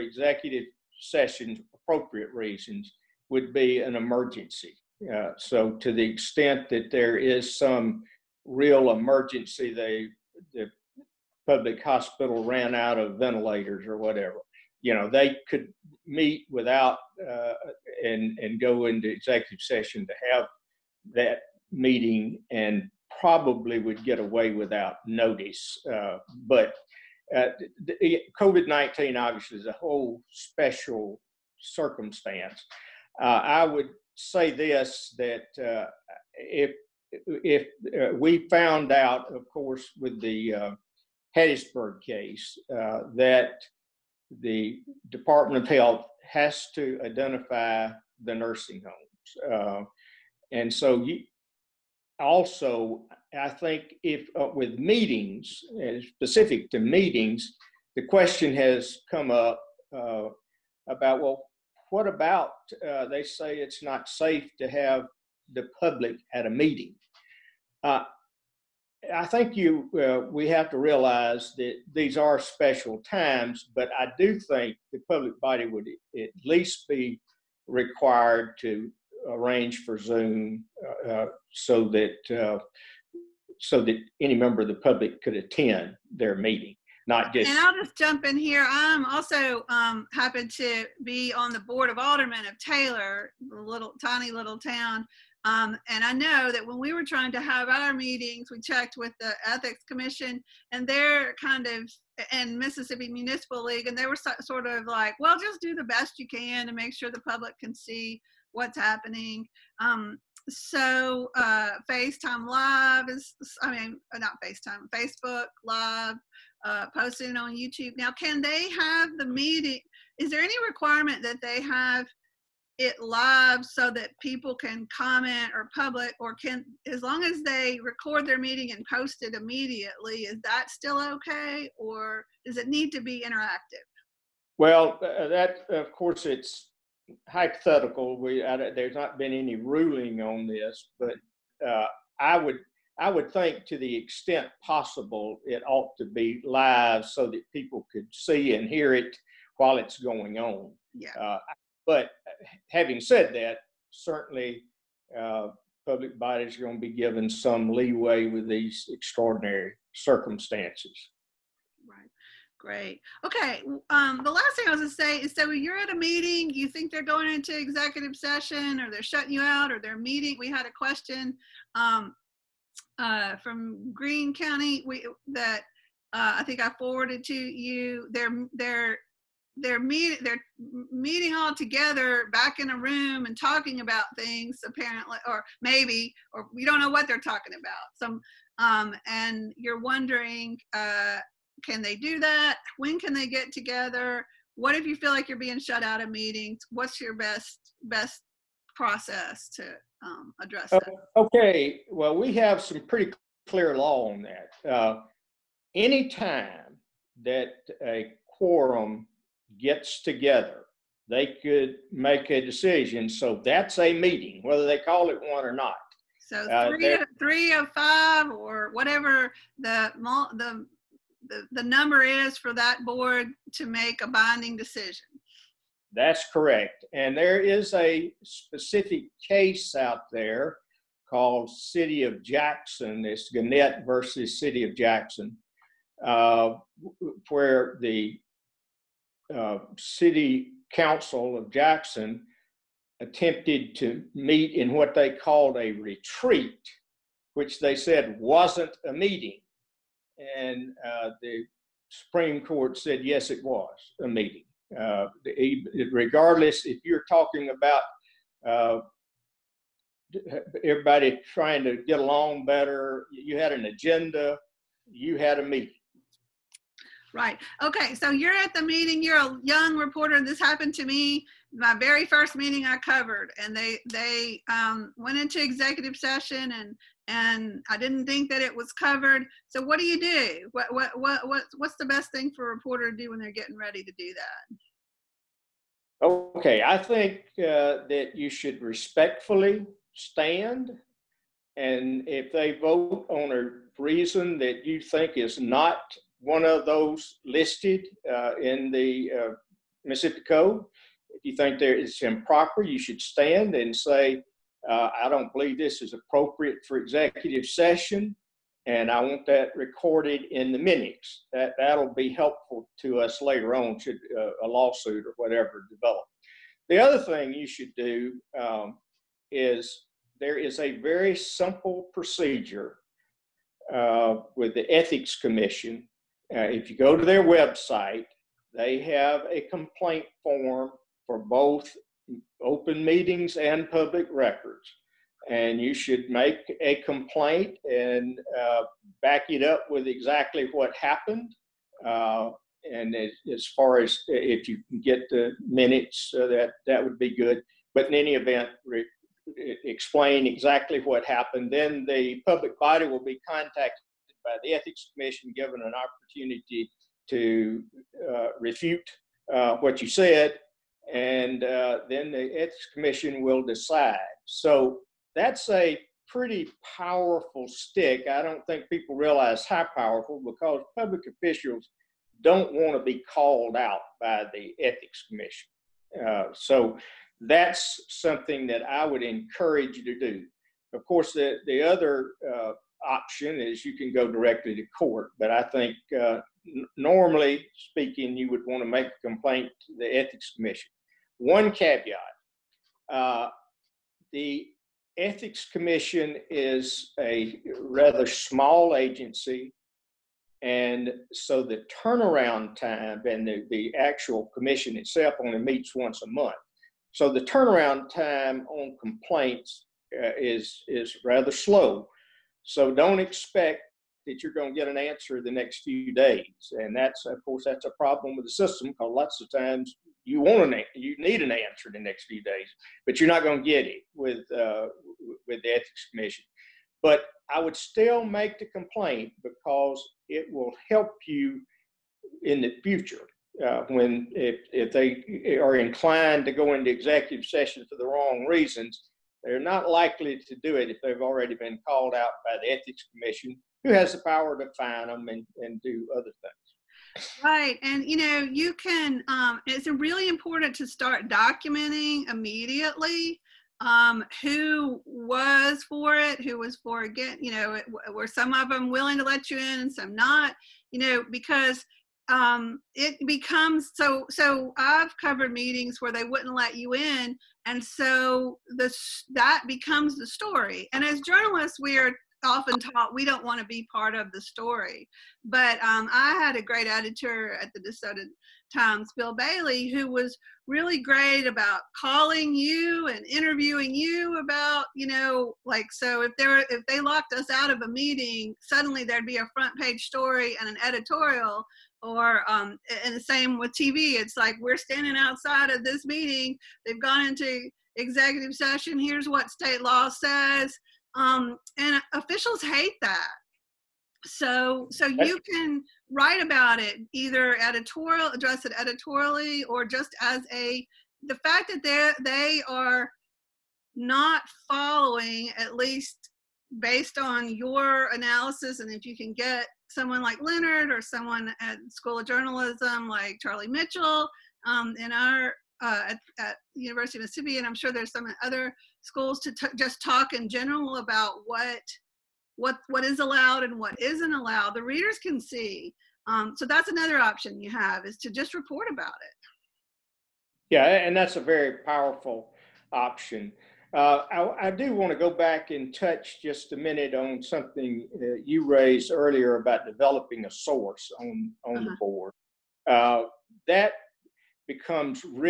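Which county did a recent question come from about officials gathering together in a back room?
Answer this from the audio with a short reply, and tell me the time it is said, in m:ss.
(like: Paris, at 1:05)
Greene County, at 2:53.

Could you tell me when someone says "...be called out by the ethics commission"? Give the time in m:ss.
6:12.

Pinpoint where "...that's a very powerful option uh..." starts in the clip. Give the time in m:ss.
9:00.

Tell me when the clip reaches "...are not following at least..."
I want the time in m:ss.
8:32.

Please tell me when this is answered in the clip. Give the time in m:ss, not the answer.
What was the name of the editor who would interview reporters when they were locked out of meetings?
7:58.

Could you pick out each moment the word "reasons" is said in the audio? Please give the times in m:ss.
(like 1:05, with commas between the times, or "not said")
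0:02, 4:53, 7:18.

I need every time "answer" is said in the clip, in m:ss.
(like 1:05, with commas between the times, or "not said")
6:54, 7:01.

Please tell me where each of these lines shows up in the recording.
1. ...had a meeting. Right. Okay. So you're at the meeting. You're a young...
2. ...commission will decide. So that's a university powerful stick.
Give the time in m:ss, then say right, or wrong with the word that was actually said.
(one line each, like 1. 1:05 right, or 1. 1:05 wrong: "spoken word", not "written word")
1. 4:25 right
2. 6:02 wrong: "pretty", not "university".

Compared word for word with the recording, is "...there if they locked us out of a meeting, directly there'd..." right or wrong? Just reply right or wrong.
wrong.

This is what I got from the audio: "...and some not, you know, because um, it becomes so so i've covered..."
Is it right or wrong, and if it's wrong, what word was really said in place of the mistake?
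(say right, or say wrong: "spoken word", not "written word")
right.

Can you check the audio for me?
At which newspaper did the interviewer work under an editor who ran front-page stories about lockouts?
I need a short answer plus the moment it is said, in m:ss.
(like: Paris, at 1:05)
Desoto Times, at 7:57.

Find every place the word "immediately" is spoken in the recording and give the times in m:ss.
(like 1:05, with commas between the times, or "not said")
2:09, 7:32.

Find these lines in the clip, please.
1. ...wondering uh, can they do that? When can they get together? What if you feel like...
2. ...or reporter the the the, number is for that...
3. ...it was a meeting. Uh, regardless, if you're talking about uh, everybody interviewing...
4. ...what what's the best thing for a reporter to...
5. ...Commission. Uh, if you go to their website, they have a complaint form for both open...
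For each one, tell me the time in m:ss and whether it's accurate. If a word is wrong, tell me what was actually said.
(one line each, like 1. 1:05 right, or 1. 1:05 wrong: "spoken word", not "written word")
1. 3:09 right
2. 3:38 wrong: "whatever", not "reporter"
3. 4:13 wrong: "trying", not "interviewing"
4. 4:41 right
5. 5:25 right.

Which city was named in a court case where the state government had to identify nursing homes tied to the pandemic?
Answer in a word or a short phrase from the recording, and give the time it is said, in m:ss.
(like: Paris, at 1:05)
Hattiesburg, at 0:41.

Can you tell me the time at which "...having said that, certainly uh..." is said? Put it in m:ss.
2:32.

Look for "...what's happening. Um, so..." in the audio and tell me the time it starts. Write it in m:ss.
1:48.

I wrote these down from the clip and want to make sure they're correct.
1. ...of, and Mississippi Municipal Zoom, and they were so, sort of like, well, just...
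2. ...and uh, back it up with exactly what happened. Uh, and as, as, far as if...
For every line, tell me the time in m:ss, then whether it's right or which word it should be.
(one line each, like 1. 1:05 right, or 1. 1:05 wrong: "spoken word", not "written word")
1. 1:41 wrong: "League", not "Zoom"
2. 5:37 right.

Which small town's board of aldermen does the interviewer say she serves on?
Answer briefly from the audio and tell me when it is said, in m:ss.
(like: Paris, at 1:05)
Taylor, at 1:32.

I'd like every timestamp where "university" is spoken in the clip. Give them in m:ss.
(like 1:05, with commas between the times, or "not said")
8:46.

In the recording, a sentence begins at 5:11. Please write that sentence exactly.
That, that'll be helpful to us later on should uh, a lawsuit or whatever develop.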